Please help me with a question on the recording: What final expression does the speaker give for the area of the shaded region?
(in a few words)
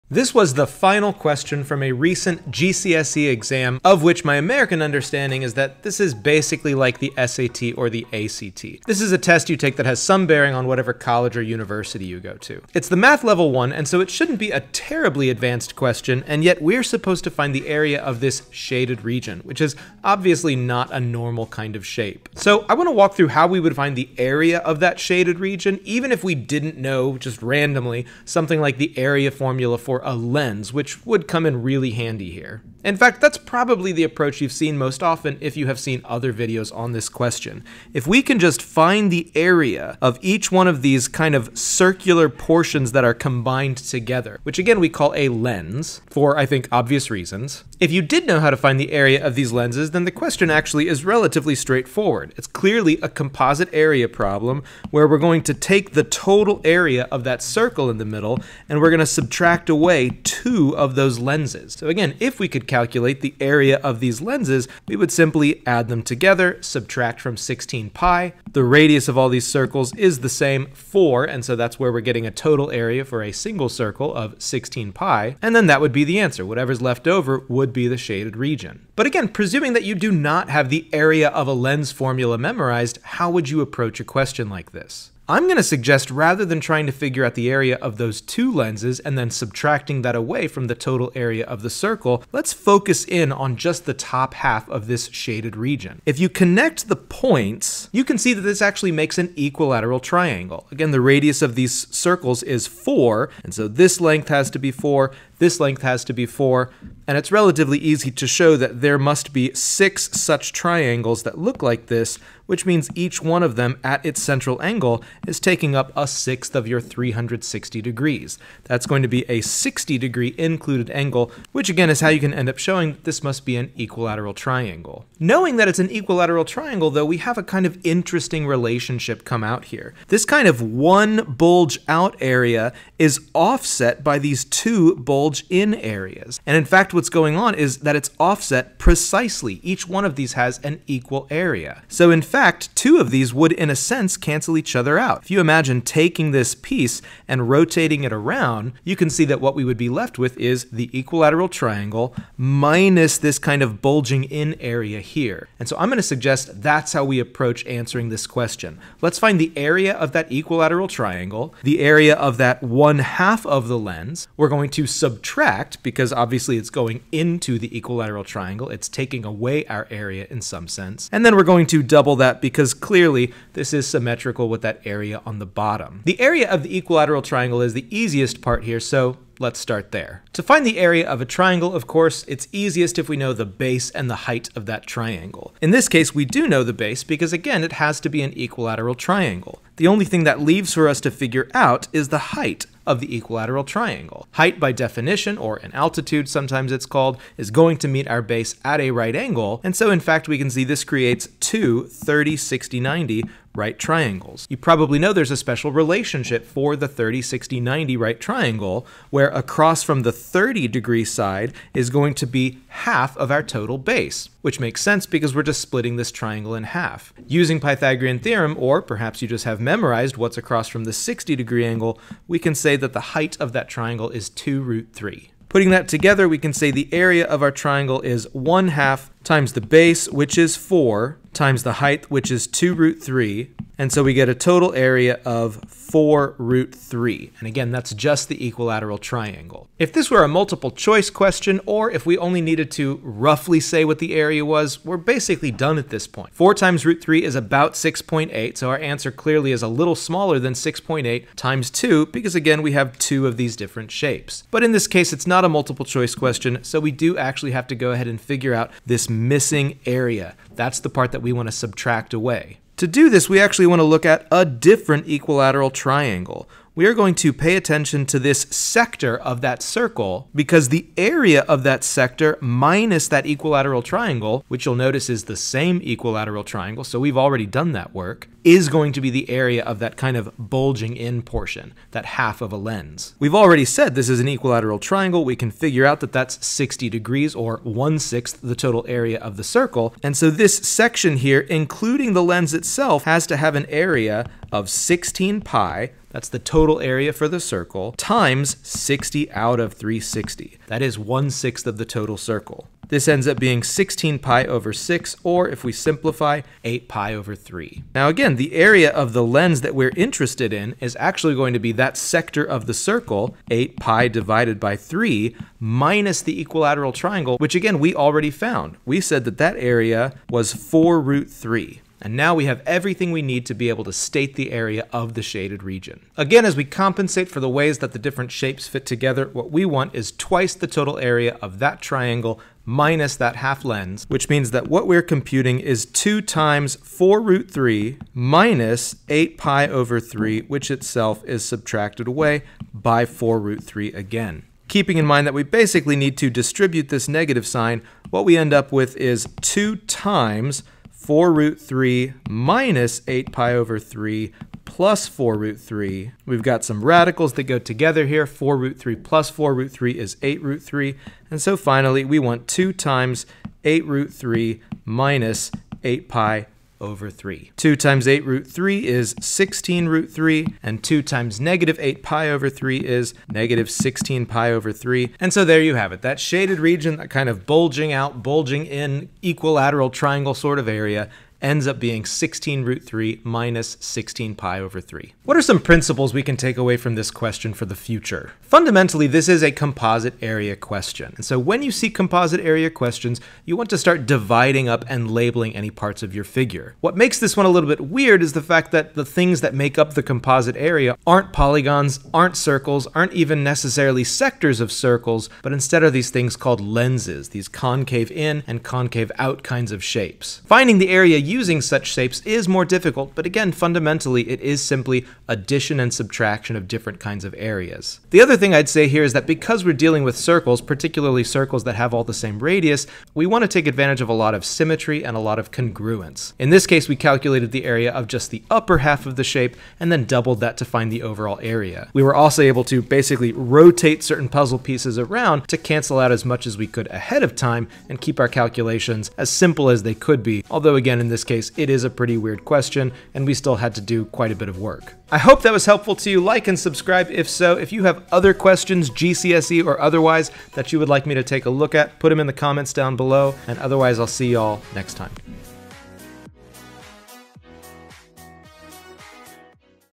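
16 root 3 minus 16 pi over 3.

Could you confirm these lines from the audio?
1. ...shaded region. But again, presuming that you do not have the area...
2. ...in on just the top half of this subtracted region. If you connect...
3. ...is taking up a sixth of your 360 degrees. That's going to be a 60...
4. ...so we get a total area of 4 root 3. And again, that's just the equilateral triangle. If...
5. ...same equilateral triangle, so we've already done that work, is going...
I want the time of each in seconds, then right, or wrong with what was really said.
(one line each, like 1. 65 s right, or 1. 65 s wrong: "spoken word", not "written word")
1. 77 s right
2. 93 s wrong: "shaded", not "subtracted"
3. 115 s right
4. 233 s right
5. 275 s right.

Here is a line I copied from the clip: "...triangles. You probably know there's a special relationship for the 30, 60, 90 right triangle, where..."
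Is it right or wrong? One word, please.
right.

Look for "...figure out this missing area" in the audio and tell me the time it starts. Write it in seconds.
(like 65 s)
258 s.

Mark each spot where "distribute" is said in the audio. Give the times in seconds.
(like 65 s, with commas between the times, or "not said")
346 s.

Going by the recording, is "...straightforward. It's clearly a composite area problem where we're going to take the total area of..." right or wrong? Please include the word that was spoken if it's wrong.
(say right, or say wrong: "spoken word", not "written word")
right.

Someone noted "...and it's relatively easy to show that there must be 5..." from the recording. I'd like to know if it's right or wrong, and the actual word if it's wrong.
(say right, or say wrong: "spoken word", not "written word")
wrong: "6", not "5".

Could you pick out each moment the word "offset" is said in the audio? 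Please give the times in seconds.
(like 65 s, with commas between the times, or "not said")
133 s, 138 s.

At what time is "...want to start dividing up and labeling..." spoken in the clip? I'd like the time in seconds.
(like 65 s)
393 s.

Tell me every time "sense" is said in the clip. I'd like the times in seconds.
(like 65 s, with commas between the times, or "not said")
143 s, 170 s, 214 s.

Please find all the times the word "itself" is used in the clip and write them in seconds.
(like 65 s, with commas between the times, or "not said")
292 s, 340 s.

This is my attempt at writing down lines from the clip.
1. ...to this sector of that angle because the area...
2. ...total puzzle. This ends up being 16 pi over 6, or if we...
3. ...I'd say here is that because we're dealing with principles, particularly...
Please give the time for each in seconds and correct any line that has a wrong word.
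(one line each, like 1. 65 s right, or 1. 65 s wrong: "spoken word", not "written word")
1. 268 s wrong: "circle", not "angle"
2. 301 s wrong: "circle", not "puzzle"
3. 418 s wrong: "circles", not "principles".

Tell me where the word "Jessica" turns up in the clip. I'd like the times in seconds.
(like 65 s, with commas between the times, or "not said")
not said.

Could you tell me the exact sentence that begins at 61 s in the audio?
So again, if we could calculate the area of these lenses, we would simply add them together, subtract from 16 pi.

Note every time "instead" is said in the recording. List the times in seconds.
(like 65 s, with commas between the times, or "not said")
405 s.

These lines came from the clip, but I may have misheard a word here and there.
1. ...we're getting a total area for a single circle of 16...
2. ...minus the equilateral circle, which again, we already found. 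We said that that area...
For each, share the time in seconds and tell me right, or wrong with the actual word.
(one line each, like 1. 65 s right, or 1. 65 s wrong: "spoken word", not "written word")
1. 71 s right
2. 315 s wrong: "triangle", not "circle".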